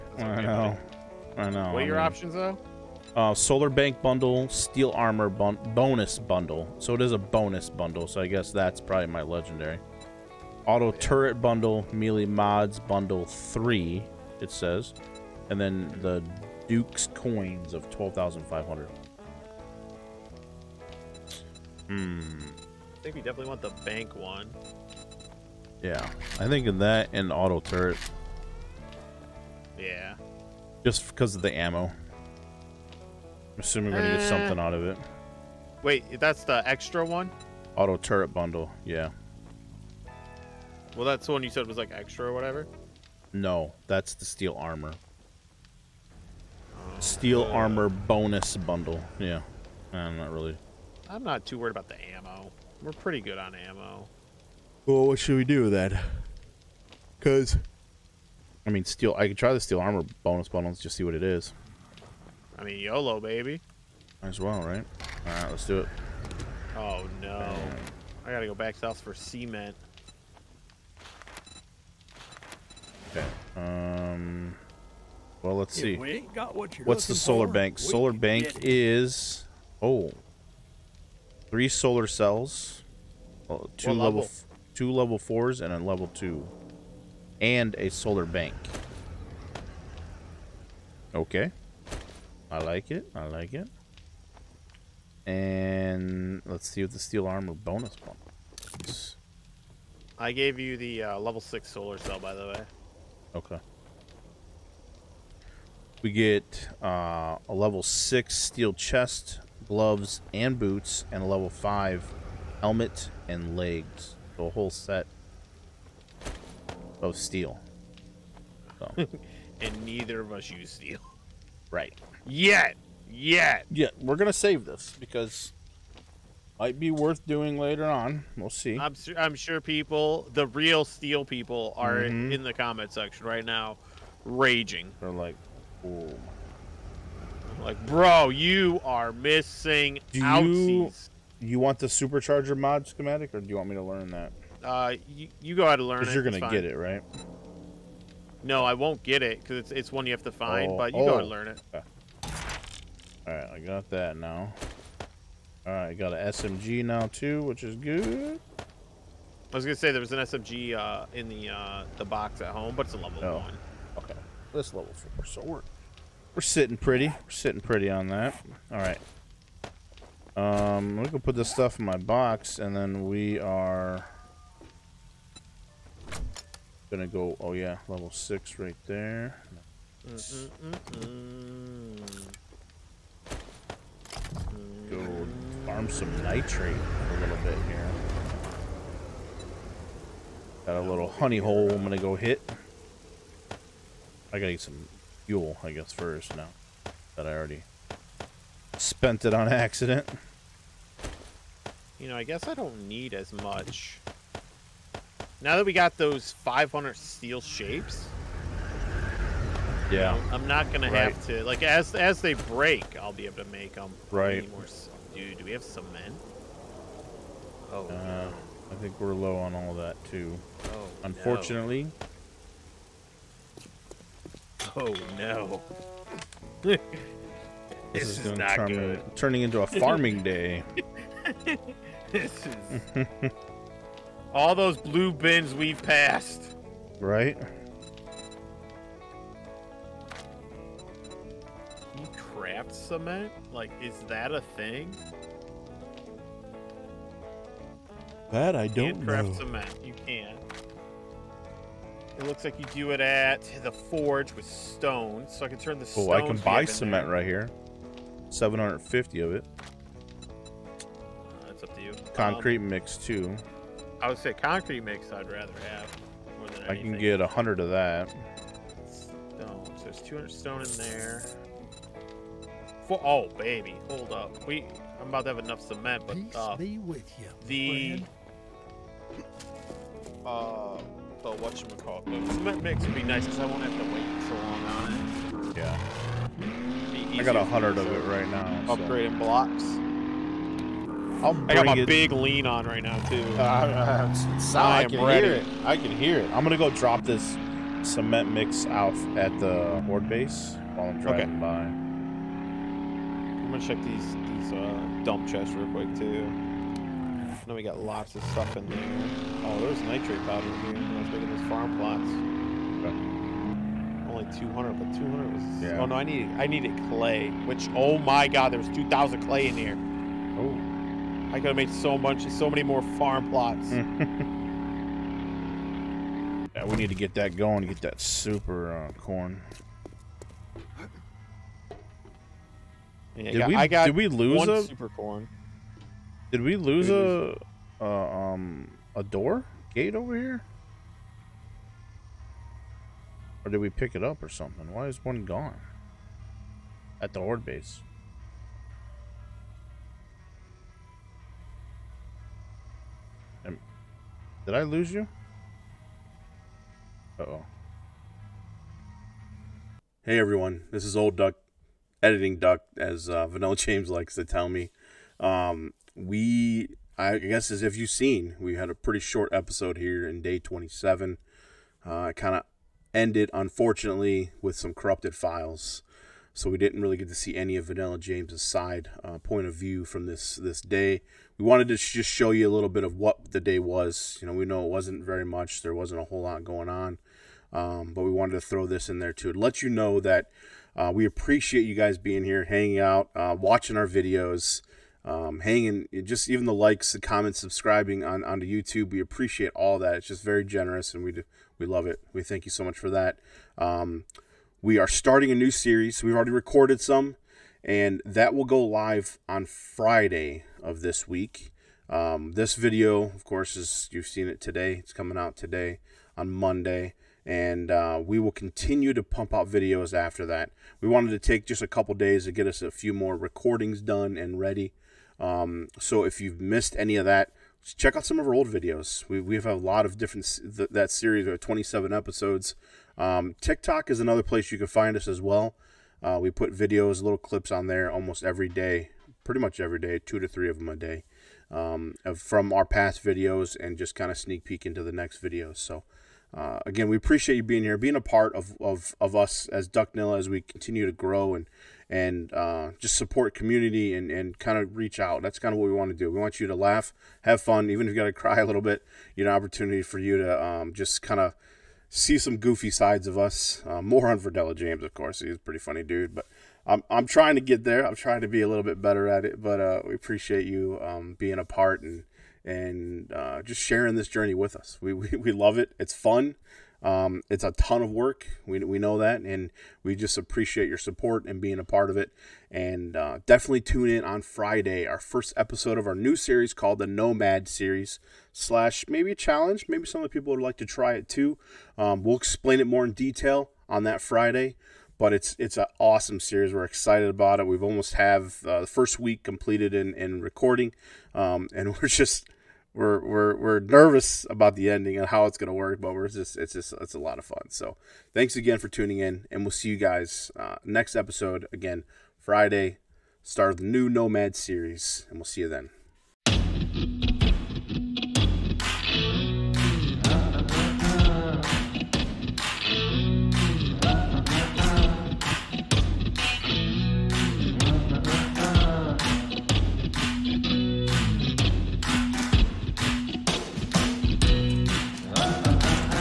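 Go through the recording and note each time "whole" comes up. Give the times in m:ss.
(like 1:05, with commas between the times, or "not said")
1:54, 6:26.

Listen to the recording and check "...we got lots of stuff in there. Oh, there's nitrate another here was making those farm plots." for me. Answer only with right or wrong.
wrong.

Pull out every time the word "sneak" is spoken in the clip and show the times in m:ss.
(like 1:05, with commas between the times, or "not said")
7:24.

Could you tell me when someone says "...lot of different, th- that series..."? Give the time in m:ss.
7:09.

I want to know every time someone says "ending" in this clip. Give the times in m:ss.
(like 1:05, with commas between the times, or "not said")
8:24.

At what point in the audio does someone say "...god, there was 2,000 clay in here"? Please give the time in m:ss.
5:18.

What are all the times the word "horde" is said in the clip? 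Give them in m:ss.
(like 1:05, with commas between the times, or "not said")
4:59, 5:47.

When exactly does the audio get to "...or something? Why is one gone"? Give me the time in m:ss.
5:44.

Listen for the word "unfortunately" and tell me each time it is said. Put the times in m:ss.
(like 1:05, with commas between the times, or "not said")
3:41, 6:13.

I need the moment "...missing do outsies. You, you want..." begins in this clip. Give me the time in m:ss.
2:19.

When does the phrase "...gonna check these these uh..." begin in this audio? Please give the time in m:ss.
5:03.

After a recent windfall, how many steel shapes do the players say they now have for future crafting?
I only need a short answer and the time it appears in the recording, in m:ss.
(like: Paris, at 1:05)
500, at 3:26.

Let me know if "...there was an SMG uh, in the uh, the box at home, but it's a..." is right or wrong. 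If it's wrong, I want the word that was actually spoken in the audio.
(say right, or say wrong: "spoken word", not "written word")
right.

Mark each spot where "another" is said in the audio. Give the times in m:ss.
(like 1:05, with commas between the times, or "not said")
7:14.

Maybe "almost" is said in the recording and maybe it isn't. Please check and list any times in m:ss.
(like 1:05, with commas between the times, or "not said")
7:17, 8:17.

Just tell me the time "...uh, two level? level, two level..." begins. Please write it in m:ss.
1:23.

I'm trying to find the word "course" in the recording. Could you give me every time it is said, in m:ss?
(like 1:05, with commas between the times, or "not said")
6:53, 7:44.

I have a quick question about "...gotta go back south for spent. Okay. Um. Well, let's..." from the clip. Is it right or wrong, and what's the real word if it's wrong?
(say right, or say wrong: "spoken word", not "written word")
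wrong: "cement", not "spent".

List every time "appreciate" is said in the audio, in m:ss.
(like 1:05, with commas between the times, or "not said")
6:31, 6:39, 7:26, 7:49, 8:00.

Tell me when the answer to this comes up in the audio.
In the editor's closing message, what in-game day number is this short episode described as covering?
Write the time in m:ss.
6:10.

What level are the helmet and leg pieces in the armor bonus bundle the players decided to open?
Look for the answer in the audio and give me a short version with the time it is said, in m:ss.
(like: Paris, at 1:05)
5, at 1:51.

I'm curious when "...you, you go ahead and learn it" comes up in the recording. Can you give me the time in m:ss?
2:25.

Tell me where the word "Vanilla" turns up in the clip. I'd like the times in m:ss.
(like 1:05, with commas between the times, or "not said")
6:03, 6:17, 7:44.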